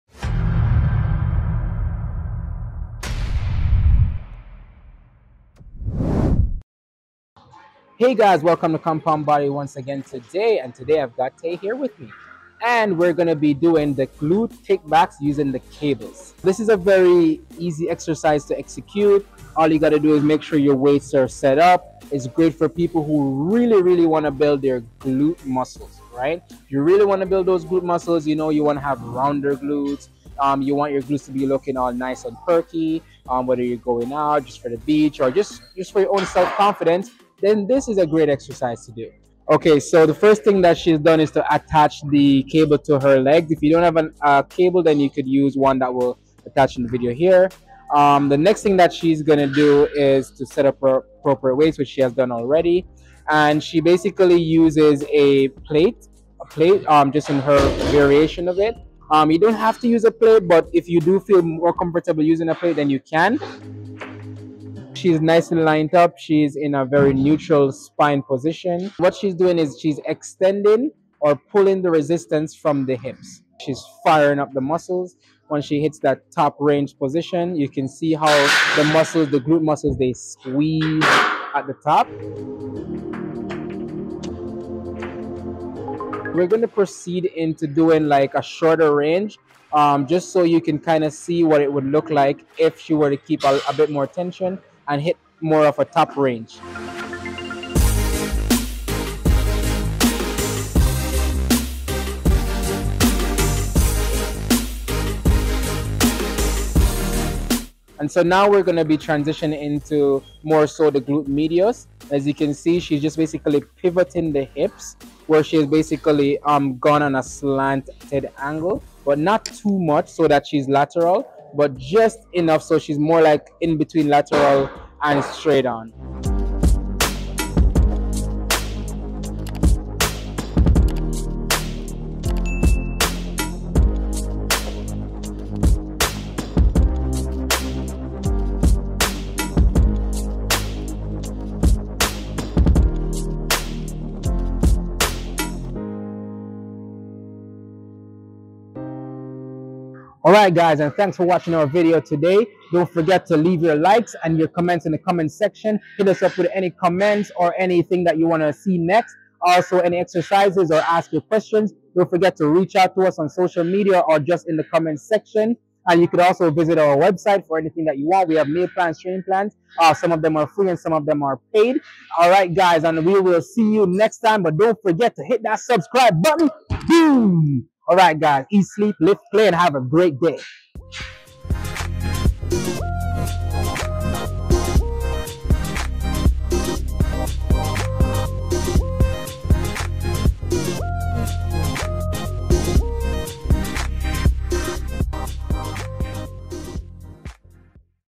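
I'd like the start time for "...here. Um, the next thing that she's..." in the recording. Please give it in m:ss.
0:47.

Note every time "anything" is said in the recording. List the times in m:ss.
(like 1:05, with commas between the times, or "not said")
2:37, 2:47.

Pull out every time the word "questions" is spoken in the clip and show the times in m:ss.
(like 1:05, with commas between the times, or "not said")
2:41.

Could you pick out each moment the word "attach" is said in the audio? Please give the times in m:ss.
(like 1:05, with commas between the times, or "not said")
0:41, 0:46.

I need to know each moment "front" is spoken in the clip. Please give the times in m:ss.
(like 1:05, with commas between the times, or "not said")
not said.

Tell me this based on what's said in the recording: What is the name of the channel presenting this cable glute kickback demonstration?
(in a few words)
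Compound Body.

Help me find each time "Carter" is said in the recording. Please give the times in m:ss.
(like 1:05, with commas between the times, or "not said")
not said.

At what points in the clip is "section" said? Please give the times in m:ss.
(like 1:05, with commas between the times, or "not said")
2:35, 2:45.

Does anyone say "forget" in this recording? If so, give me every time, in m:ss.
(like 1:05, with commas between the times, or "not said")
2:32, 2:42, 2:54.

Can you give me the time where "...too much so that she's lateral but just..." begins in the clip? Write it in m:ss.
1:59.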